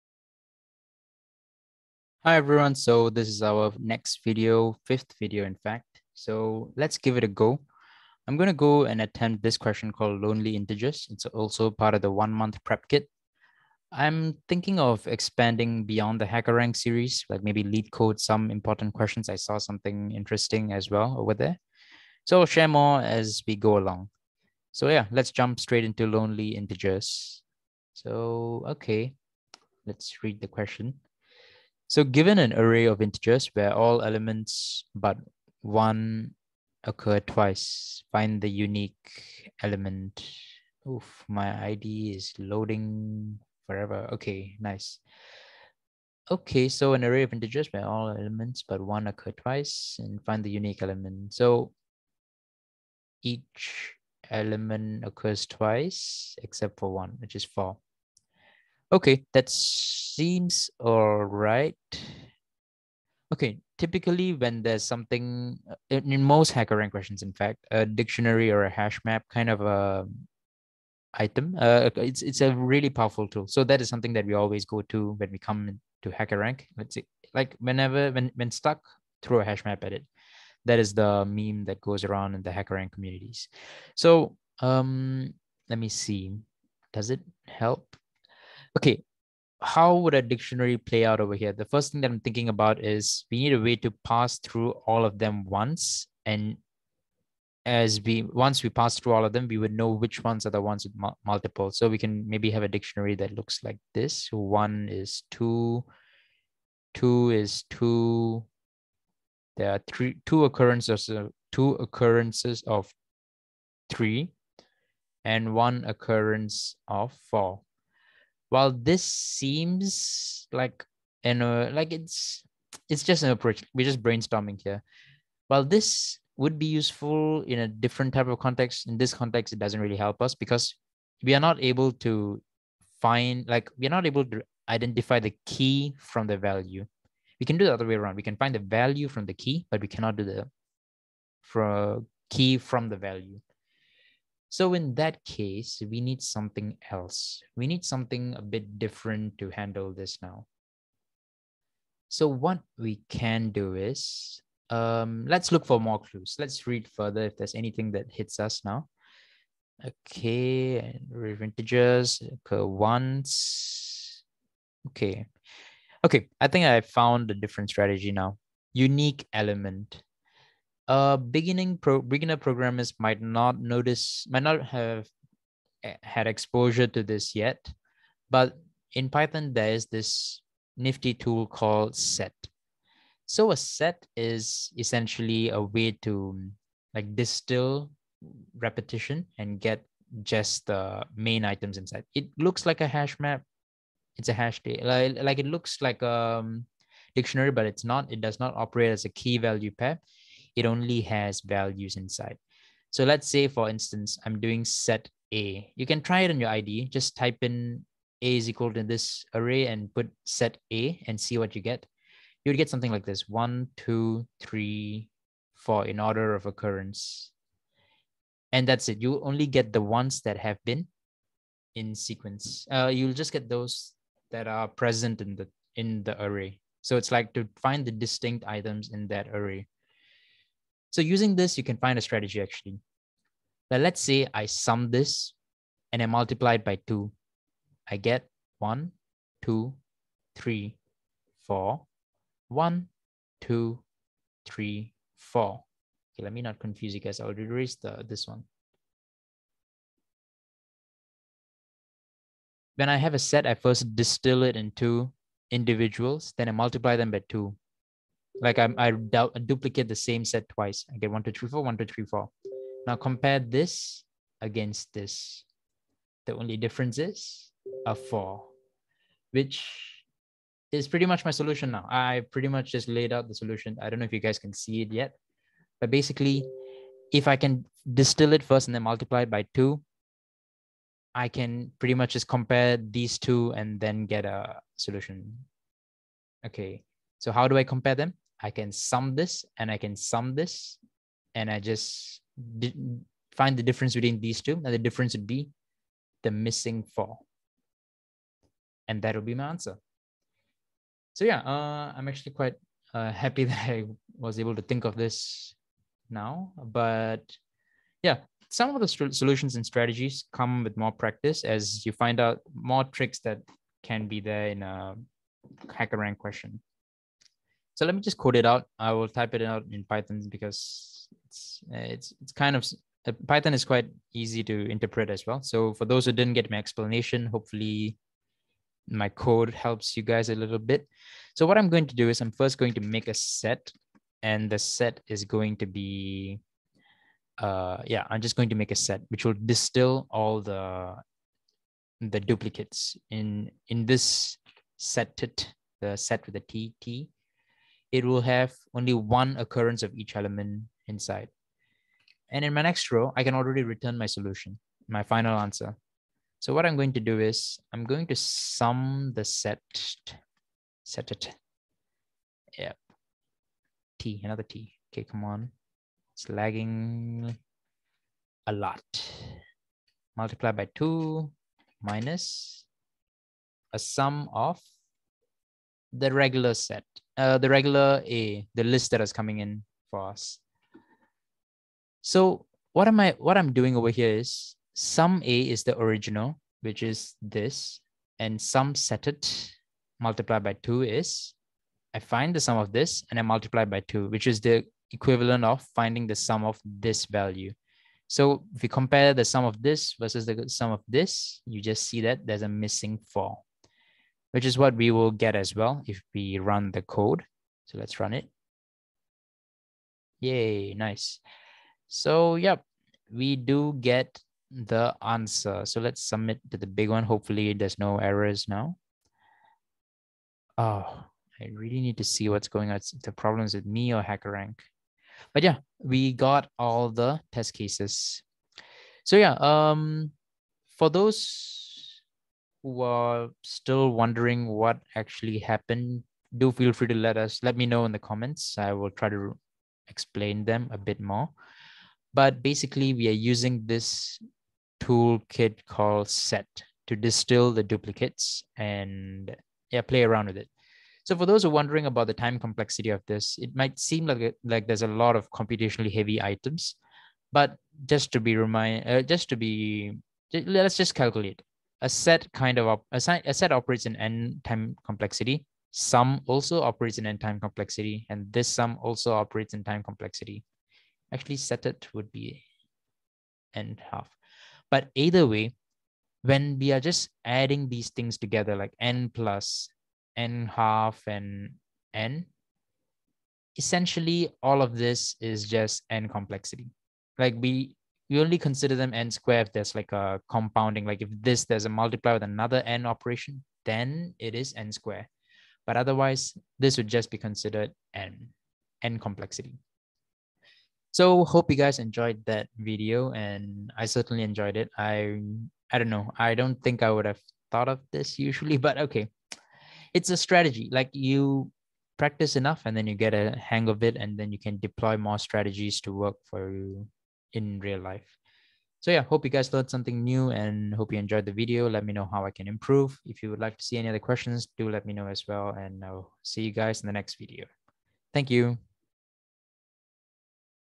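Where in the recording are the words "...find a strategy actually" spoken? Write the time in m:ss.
3:51.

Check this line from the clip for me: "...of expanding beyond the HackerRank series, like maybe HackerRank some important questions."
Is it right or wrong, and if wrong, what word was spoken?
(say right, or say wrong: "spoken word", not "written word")
wrong: "LeetCode", not "HackerRank".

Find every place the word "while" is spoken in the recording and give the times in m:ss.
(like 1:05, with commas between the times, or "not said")
1:58, 2:05.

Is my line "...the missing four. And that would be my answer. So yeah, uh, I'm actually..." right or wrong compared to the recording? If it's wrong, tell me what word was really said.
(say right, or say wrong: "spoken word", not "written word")
right.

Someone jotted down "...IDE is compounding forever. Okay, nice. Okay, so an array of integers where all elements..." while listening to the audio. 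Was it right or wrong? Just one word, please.
wrong.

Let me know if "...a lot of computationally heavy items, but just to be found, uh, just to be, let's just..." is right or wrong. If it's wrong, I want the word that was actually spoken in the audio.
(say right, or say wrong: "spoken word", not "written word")
wrong: "remind", not "found".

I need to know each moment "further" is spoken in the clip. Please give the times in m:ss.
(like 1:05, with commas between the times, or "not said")
2:36.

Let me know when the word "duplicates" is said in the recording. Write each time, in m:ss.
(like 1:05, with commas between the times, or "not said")
4:19, 5:42, 7:27.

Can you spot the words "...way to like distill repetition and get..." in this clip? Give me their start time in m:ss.
3:05.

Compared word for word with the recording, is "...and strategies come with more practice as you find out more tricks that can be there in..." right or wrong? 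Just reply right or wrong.
right.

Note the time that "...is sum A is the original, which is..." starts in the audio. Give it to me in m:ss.
6:24.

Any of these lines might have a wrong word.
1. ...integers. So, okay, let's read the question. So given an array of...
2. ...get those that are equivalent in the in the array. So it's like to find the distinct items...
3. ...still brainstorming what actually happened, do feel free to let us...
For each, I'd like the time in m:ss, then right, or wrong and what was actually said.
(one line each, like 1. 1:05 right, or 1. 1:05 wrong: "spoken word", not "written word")
1. 0:26 right
2. 3:43 wrong: "present", not "equivalent"
3. 7:13 wrong: "wondering", not "brainstorming".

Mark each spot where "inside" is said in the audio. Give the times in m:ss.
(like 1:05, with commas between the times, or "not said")
3:11, 3:21, 5:50.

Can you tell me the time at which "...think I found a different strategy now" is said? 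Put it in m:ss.
2:46.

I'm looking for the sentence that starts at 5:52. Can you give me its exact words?
And in my next row, I can already return my solution, my final answer.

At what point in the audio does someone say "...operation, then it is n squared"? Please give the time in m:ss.
8:12.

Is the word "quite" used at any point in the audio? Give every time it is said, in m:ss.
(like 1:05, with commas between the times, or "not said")
5:02, 5:23.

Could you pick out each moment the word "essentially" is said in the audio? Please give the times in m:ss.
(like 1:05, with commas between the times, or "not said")
3:04, 8:03.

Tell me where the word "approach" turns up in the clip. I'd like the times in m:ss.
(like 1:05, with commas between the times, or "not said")
2:03.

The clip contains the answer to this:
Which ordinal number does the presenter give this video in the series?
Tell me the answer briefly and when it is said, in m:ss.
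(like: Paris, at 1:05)
Fifth, at 0:04.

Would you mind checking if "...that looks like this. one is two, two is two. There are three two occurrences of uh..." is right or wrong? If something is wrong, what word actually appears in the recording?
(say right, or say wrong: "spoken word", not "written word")
right.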